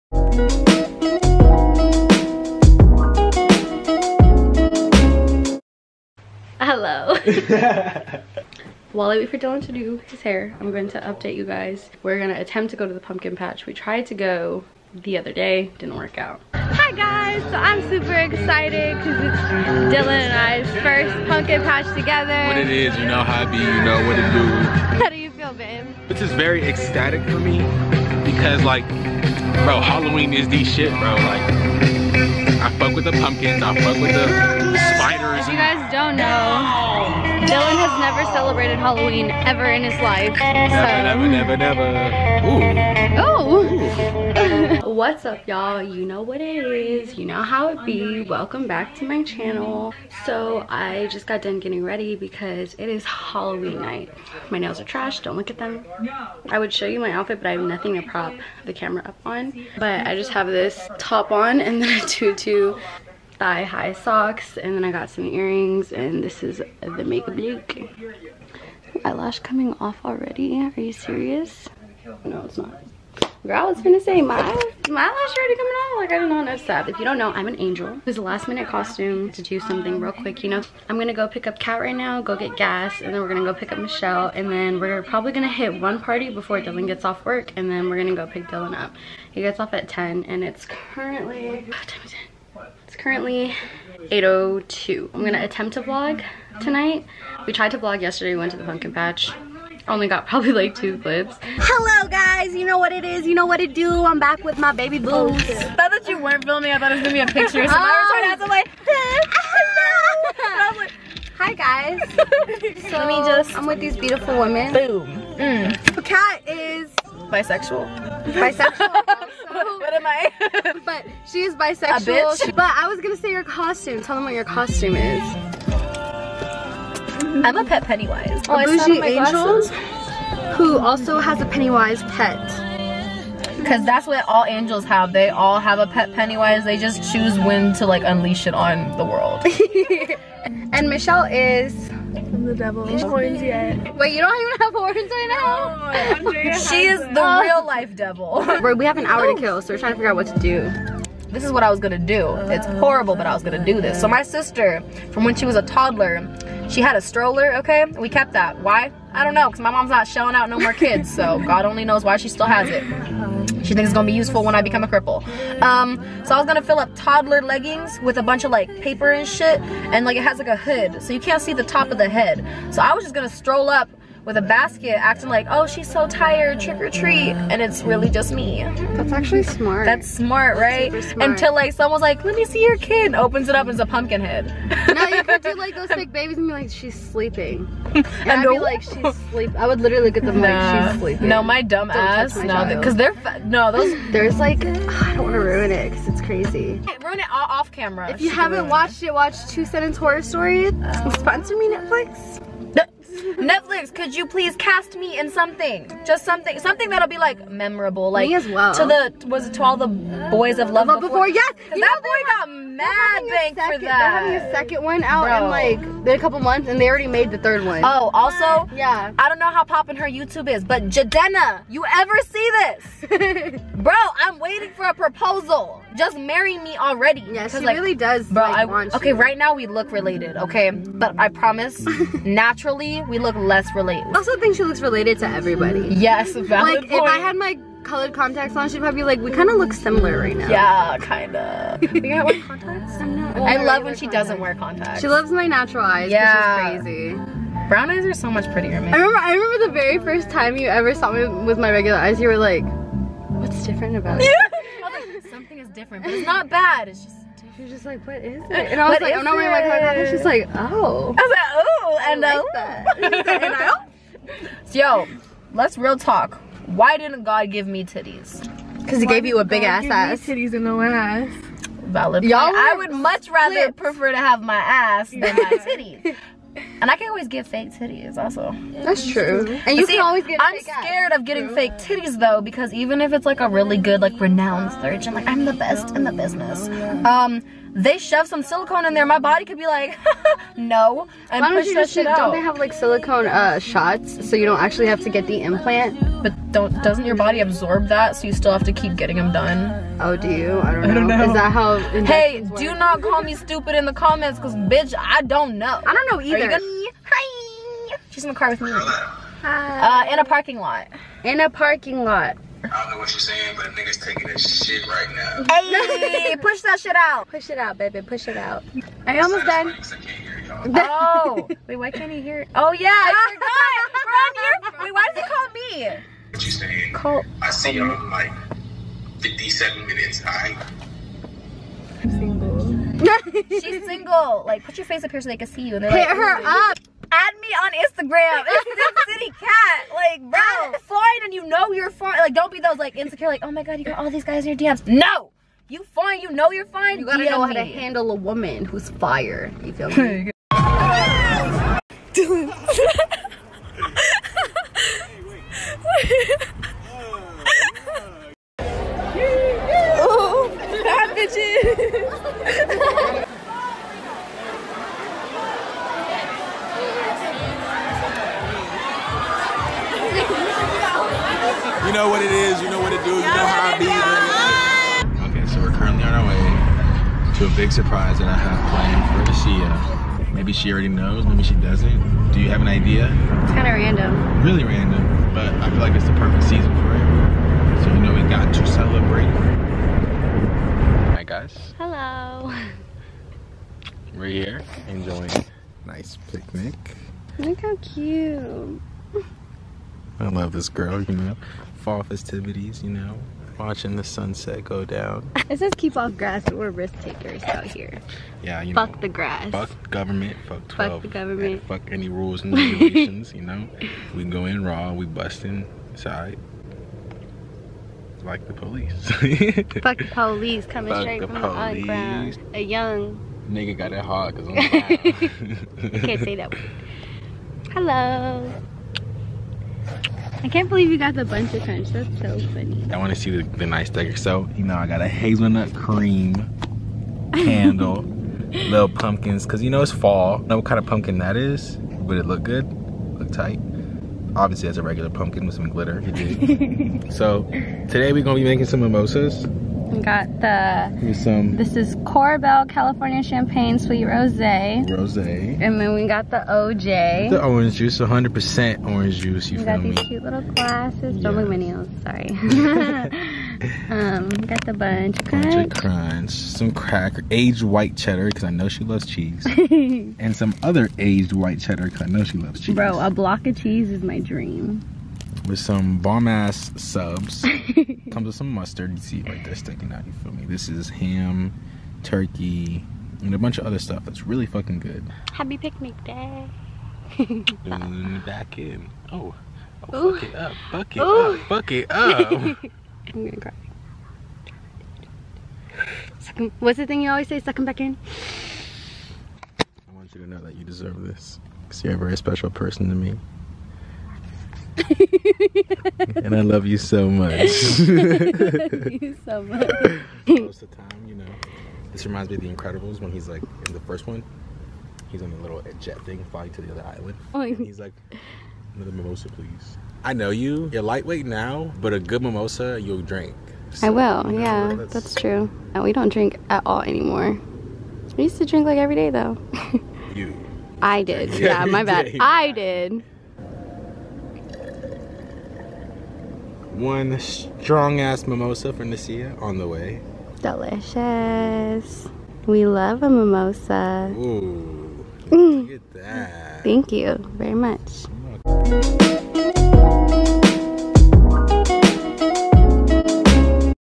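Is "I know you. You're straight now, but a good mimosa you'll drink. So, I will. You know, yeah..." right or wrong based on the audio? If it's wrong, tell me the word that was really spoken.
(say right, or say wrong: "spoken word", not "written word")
wrong: "lightweight", not "straight".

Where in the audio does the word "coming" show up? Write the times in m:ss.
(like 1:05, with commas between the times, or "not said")
1:09, 1:15, 7:00.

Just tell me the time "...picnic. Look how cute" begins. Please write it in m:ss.
6:36.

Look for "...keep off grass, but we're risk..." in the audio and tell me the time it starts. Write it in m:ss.
6:45.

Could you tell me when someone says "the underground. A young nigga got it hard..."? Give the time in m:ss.
7:01.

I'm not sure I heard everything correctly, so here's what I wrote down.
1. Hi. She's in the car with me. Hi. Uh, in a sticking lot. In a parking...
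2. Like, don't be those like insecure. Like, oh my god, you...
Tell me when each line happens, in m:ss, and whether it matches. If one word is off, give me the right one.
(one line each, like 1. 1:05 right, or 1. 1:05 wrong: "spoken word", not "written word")
1. 5:07 wrong: "parking", not "sticking"
2. 5:42 right.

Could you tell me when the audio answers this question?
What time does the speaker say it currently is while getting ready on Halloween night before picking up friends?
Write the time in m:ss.
1:34.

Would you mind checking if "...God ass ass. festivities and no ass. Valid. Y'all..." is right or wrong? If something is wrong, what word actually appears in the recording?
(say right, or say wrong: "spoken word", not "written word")
wrong: "titties", not "festivities".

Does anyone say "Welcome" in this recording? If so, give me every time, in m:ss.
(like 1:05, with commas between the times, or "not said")
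0:48.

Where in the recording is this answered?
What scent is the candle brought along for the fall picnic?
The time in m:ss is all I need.
7:15.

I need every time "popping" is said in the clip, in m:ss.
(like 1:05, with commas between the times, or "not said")
3:39.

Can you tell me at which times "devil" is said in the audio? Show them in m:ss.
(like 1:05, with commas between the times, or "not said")
2:22, 2:27.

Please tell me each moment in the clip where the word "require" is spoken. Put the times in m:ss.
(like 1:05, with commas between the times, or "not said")
not said.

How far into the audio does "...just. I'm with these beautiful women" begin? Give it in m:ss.
1:53.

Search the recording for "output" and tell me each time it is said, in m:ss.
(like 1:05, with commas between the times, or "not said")
not said.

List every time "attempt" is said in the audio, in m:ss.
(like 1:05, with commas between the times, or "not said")
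0:12, 1:35.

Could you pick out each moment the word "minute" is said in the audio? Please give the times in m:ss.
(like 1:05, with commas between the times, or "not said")
1:18, 5:29.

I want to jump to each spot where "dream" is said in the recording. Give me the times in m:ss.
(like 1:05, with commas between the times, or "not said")
7:54.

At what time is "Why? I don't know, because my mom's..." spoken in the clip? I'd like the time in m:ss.
2:38.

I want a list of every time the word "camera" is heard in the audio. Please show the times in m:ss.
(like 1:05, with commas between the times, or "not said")
0:58, 3:17.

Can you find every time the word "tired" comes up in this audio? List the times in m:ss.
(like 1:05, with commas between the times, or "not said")
2:56.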